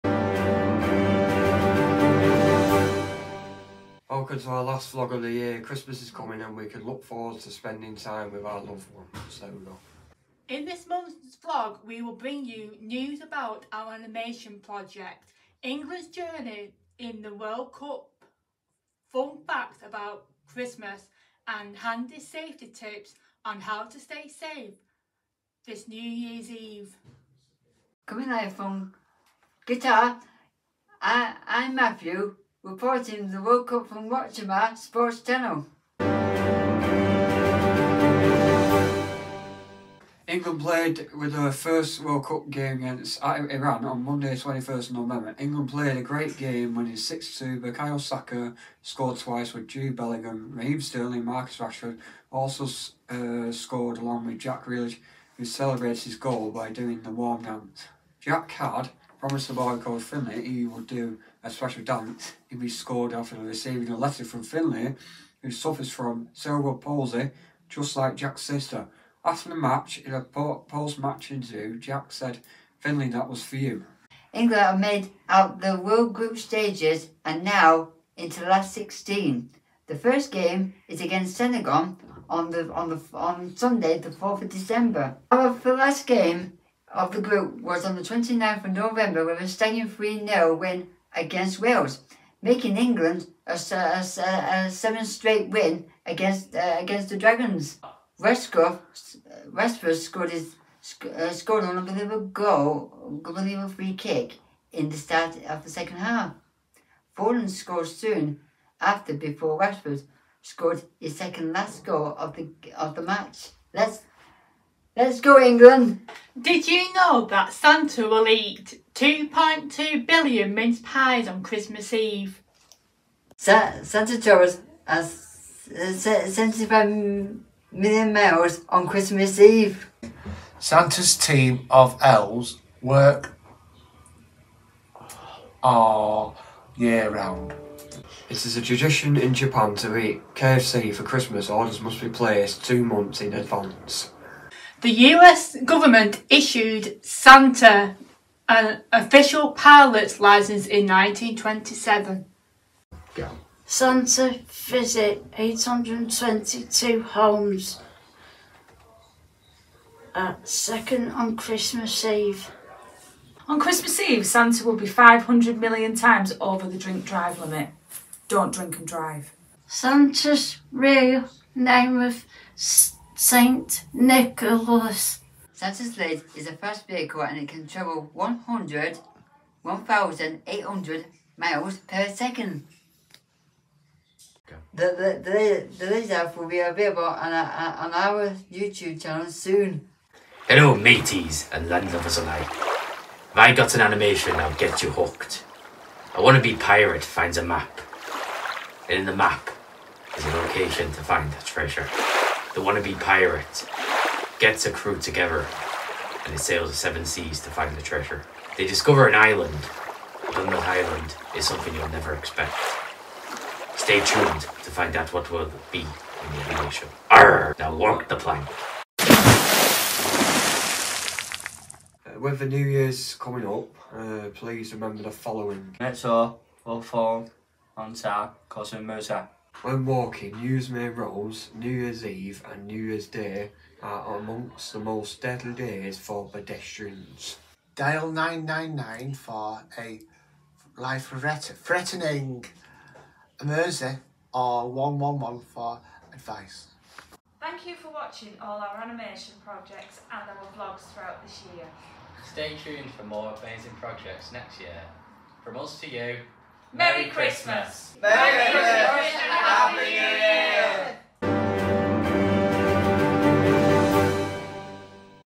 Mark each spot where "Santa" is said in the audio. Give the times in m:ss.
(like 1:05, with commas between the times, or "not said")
1:57, 2:03, 2:10, 2:27, 2:33, 2:44, 2:49, 2:55.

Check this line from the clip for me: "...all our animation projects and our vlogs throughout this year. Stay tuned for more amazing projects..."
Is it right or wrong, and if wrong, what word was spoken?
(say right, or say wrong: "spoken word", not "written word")
right.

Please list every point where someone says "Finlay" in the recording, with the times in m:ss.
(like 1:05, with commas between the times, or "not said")
1:00, 1:04, 1:12.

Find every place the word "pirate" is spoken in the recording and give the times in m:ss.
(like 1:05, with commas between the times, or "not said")
3:16, 3:22.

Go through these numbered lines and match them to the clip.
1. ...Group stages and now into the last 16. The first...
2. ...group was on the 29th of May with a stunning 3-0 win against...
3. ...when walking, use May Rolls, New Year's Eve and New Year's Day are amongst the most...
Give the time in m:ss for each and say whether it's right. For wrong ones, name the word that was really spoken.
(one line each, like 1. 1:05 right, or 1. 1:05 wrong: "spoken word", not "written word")
1. 1:16 right
2. 1:27 wrong: "November", not "May"
3. 3:49 right.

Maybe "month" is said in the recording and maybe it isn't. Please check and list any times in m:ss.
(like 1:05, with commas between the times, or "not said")
0:10, 2:22.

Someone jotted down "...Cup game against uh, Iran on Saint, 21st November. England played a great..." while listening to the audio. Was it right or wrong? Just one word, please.
wrong.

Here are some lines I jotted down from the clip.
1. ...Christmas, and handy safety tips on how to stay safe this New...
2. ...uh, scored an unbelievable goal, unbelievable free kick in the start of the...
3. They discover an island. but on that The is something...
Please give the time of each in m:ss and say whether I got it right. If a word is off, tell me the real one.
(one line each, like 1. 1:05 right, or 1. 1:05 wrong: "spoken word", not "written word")
1. 0:20 right
2. 1:41 right
3. 3:28 wrong: "Island", not "The".